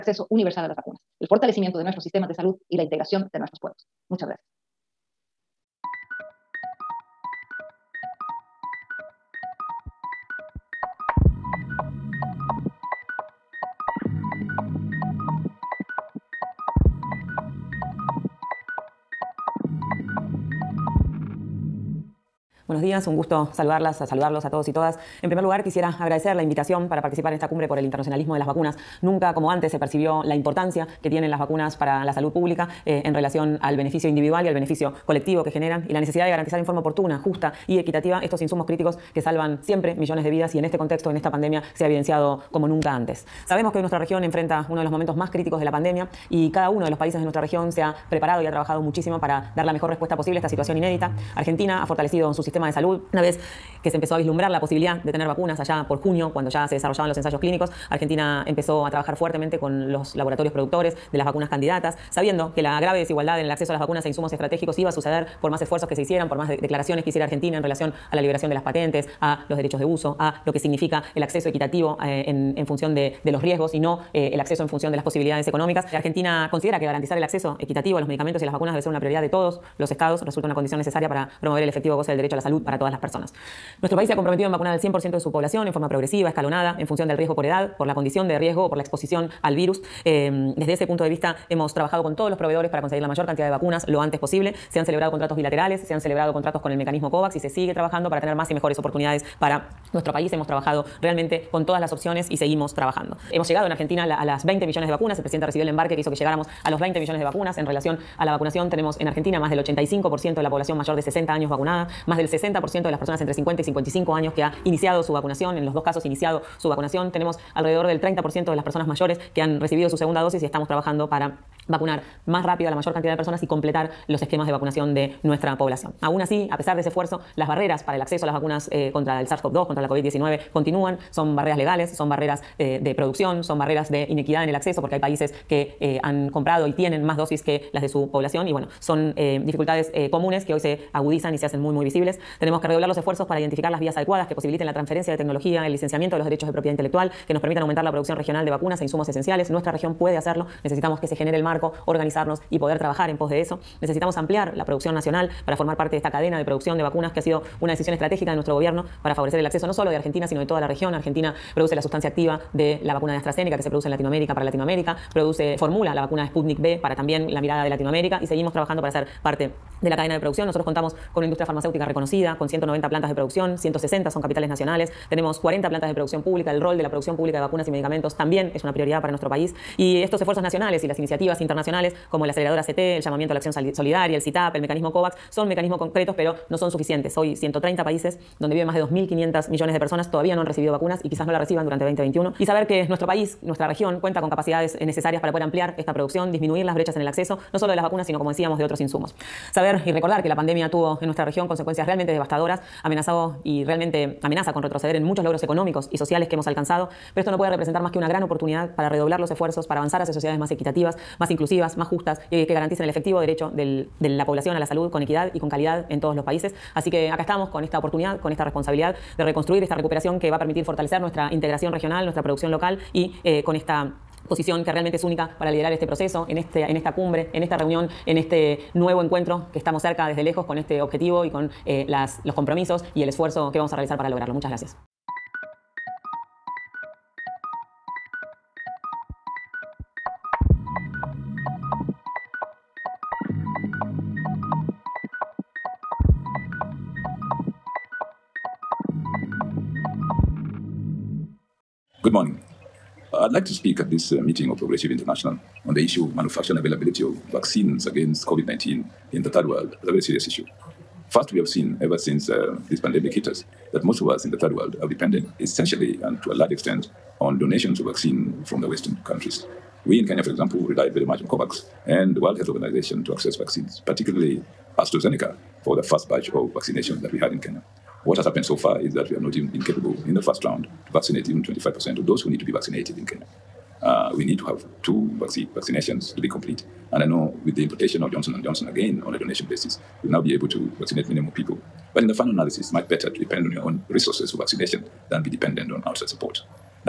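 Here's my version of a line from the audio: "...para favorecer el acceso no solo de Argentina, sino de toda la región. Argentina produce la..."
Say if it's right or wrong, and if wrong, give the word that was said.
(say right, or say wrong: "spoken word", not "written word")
right.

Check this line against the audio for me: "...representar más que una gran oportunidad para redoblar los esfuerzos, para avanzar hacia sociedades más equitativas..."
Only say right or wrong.
right.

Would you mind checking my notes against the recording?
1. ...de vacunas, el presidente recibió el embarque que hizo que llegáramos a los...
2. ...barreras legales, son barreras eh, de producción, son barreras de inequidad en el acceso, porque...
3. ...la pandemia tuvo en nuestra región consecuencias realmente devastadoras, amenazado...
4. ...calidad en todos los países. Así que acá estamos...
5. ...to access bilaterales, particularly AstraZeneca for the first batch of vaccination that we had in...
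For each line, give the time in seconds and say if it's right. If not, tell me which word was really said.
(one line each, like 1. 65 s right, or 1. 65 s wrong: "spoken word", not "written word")
1. 104 s right
2. 131 s right
3. 200 s right
4. 215 s right
5. 273 s wrong: "vaccines", not "bilaterales".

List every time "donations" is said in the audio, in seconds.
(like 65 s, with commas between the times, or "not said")
267 s, 289 s.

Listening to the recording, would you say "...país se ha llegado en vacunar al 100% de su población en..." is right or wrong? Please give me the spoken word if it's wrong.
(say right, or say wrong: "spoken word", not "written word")
wrong: "comprometido", not "llegado".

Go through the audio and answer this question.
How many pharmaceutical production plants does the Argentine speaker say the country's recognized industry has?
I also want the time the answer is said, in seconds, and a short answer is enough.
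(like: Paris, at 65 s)
190, at 172 s.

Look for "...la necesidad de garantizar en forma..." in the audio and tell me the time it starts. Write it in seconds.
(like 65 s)
35 s.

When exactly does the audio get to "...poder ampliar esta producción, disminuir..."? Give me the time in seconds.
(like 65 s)
195 s.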